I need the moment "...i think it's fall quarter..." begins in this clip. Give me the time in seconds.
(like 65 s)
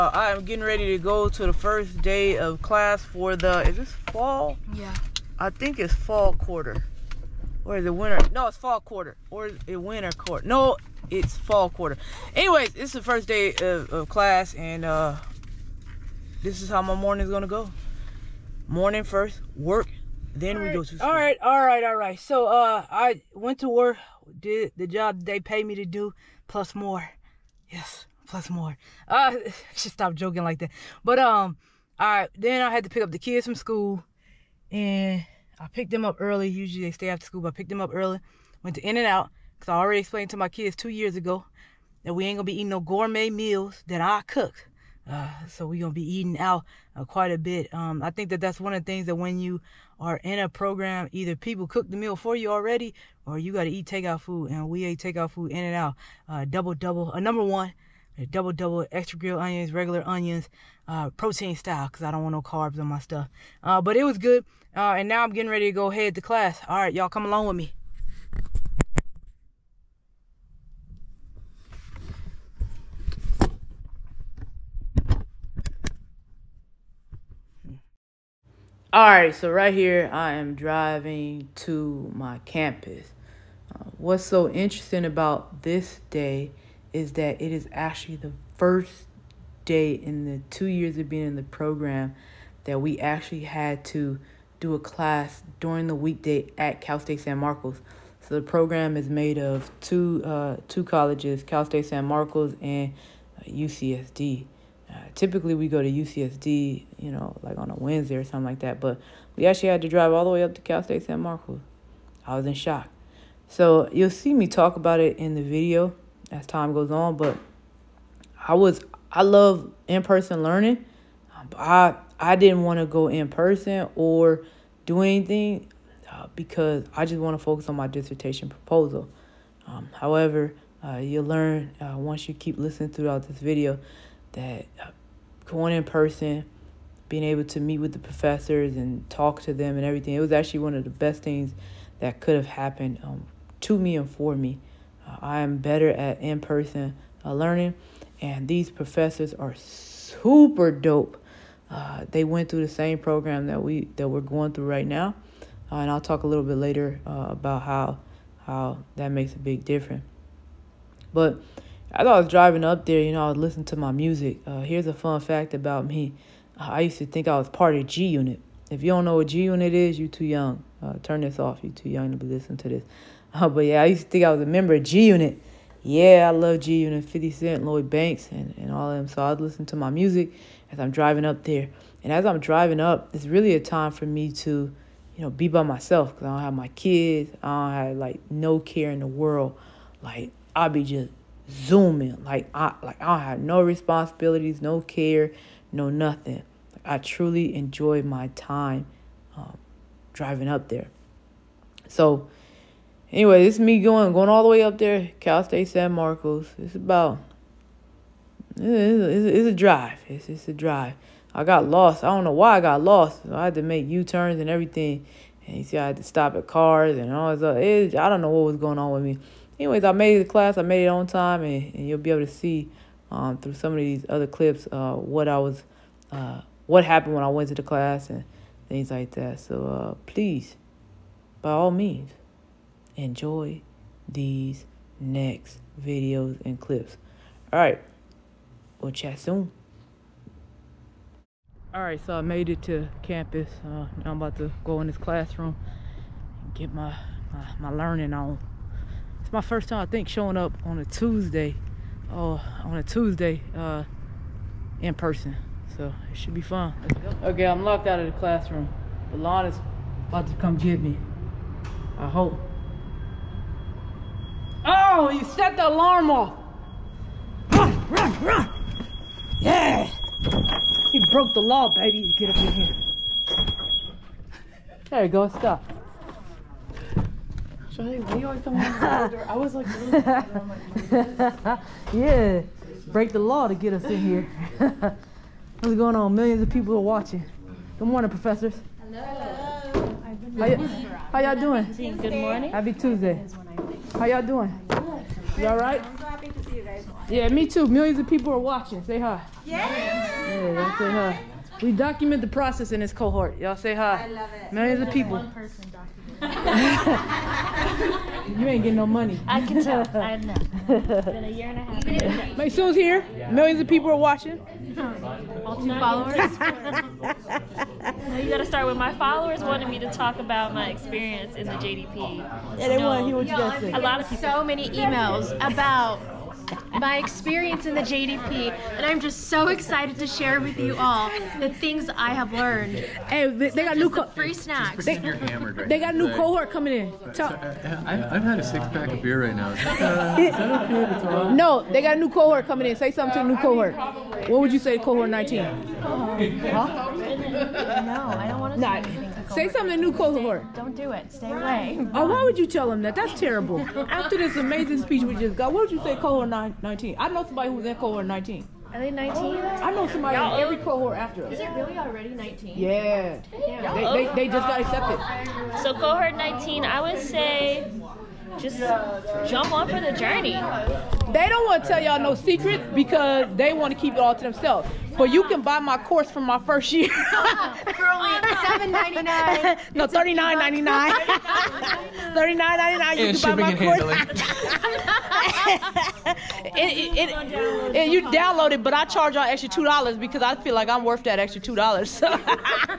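5 s.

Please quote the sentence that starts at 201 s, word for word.
So anyway, this is me going going all the way up there, Cal State San Marcos.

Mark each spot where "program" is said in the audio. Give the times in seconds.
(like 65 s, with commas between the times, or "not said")
50 s, 91 s, 98 s, 152 s.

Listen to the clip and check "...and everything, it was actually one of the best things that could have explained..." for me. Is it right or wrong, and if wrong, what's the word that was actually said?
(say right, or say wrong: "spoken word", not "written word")
wrong: "happened", not "explained".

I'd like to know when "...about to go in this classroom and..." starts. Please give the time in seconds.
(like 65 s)
244 s.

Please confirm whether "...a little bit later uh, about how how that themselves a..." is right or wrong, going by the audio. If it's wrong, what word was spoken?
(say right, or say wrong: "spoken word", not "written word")
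wrong: "makes", not "themselves".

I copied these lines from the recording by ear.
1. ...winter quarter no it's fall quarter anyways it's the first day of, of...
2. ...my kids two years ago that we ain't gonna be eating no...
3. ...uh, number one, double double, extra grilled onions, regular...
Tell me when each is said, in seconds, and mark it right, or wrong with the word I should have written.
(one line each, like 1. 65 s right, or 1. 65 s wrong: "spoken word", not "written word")
1. 9 s right
2. 40 s right
3. 57 s right.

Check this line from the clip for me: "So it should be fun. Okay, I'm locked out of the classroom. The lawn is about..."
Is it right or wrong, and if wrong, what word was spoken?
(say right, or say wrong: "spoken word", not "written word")
right.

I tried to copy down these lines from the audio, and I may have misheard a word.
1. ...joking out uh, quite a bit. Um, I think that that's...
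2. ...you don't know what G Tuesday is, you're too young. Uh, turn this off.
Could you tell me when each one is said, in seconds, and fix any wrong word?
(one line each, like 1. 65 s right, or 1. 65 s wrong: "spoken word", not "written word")
1. 46 s wrong: "eating", not "joking"
2. 168 s wrong: "Unit", not "Tuesday".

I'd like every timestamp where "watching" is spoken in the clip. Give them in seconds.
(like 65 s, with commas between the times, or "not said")
286 s, 298 s, 313 s.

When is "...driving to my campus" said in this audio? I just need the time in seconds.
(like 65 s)
80 s.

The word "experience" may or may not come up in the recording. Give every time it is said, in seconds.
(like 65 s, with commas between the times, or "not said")
320 s, 326 s.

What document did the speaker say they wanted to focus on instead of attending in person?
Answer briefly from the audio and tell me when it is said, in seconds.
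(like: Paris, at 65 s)
dissertation proposal, at 127 s.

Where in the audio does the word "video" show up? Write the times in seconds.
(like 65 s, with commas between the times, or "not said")
115 s, 133 s, 235 s.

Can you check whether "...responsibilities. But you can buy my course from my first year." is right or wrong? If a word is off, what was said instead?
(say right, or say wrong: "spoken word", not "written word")
wrong: "themselves", not "responsibilities".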